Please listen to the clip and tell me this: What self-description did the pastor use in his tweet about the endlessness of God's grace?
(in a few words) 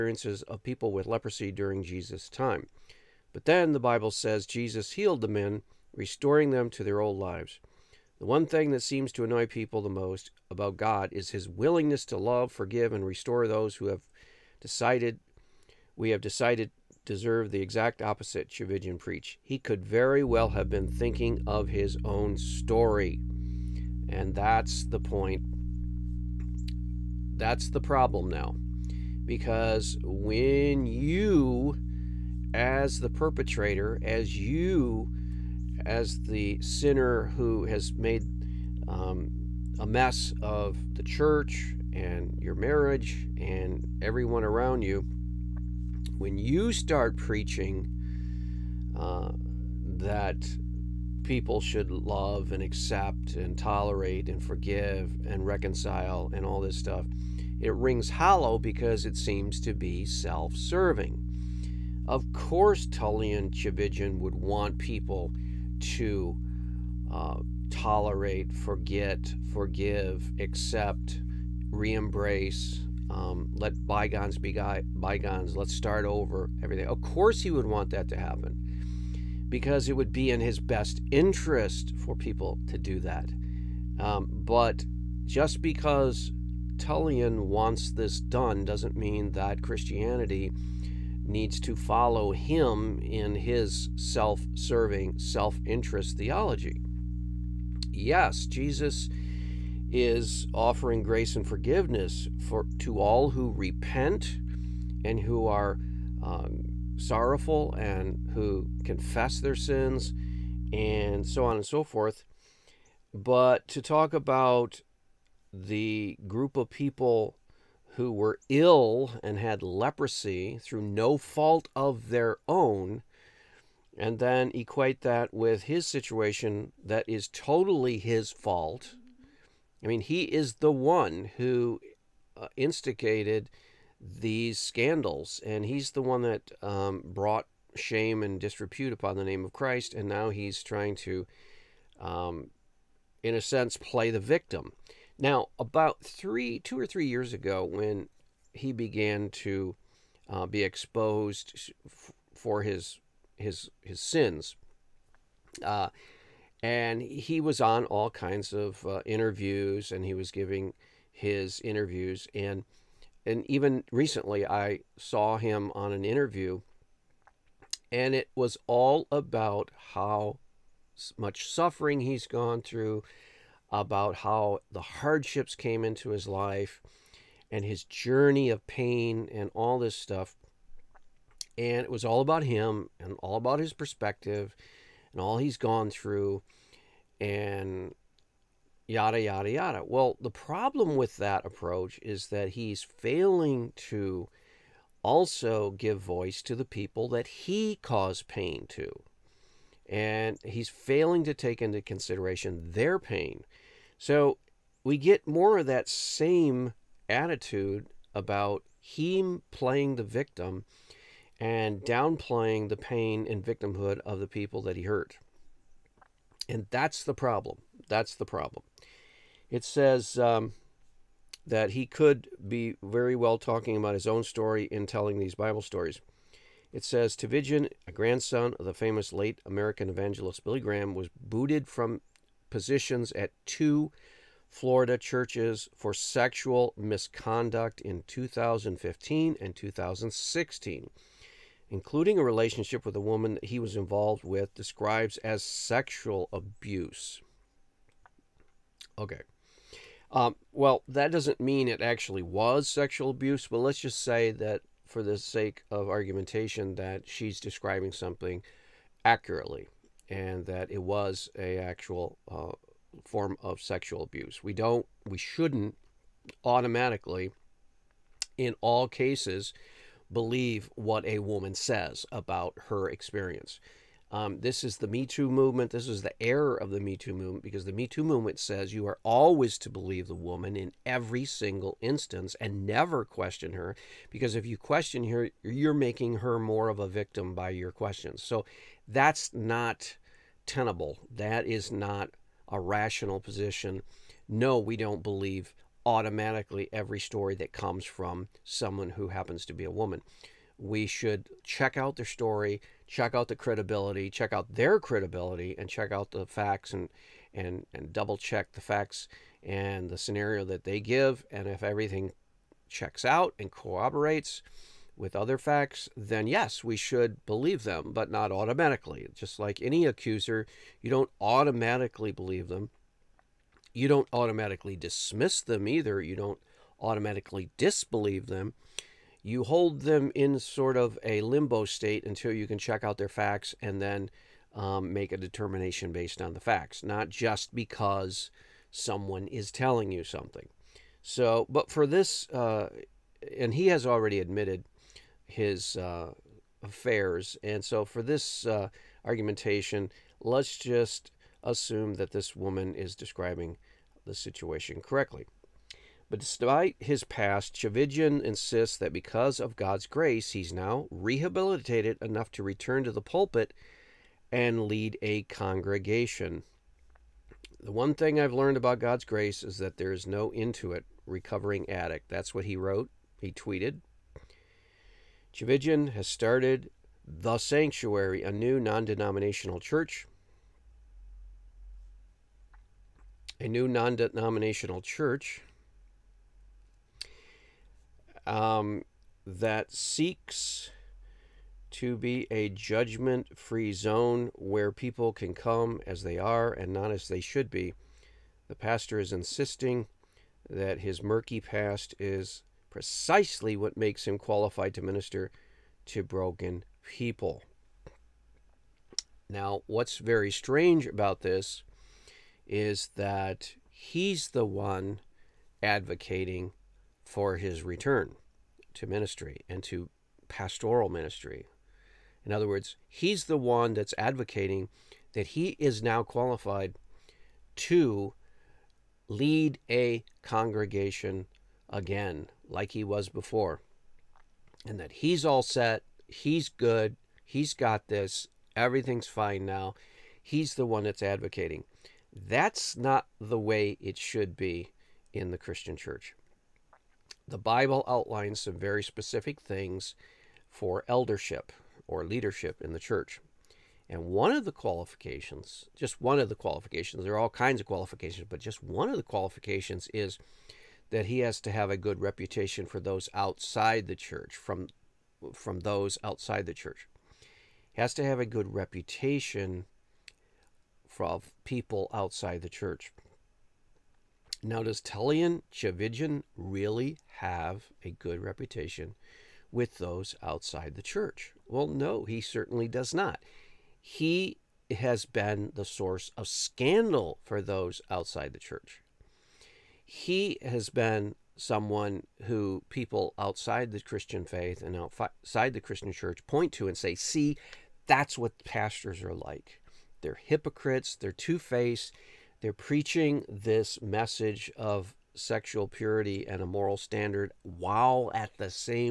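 Recovering addict.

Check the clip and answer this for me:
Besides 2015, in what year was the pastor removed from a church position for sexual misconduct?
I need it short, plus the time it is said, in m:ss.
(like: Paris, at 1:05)
2016, at 3:59.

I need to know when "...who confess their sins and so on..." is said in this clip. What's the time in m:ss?
1:48.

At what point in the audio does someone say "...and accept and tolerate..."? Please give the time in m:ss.
0:52.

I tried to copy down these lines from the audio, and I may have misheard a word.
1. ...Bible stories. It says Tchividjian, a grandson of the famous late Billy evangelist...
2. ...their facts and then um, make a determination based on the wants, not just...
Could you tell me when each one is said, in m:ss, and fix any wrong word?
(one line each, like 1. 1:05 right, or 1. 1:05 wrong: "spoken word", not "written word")
1. 3:45 wrong: "American", not "Billy"
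2. 5:32 wrong: "facts", not "wants".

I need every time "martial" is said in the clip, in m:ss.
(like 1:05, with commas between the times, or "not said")
not said.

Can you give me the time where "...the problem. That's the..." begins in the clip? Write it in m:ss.
3:37.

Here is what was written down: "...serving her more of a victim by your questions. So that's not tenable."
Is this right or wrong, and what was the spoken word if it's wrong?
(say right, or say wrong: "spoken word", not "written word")
wrong: "making", not "serving".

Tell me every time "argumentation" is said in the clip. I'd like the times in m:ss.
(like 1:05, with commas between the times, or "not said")
4:15, 5:49.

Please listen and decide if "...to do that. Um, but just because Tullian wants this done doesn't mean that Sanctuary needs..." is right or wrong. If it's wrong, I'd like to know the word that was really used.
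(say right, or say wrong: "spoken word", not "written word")
wrong: "Christianity", not "Sanctuary".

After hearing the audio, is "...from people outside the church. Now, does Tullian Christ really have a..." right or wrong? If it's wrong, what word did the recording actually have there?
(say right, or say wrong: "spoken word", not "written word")
wrong: "Tchividjian", not "Christ".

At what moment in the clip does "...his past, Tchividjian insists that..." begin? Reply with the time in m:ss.
5:56.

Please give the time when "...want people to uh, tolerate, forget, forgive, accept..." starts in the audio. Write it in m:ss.
1:04.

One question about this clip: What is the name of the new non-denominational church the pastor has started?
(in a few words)
The Sanctuary.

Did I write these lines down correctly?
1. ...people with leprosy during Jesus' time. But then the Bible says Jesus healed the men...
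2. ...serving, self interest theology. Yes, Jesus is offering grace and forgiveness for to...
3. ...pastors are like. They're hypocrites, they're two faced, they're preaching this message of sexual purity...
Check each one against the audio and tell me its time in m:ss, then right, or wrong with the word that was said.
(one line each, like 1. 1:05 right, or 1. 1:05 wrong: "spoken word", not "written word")
1. 0:00 right
2. 1:34 right
3. 8:18 right.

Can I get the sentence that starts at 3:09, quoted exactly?
Well, the problem with that approach is that he's failing to also give voice to the people that he caused pain to.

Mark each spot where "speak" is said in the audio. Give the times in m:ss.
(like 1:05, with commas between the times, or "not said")
not said.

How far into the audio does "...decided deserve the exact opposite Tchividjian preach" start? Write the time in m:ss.
0:16.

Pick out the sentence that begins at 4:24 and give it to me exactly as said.
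We don't, we shouldn't automatically, in all cases, believe what a woman says about her experience.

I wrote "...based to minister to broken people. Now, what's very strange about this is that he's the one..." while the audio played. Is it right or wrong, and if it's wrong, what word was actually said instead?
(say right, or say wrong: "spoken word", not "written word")
wrong: "qualified", not "based".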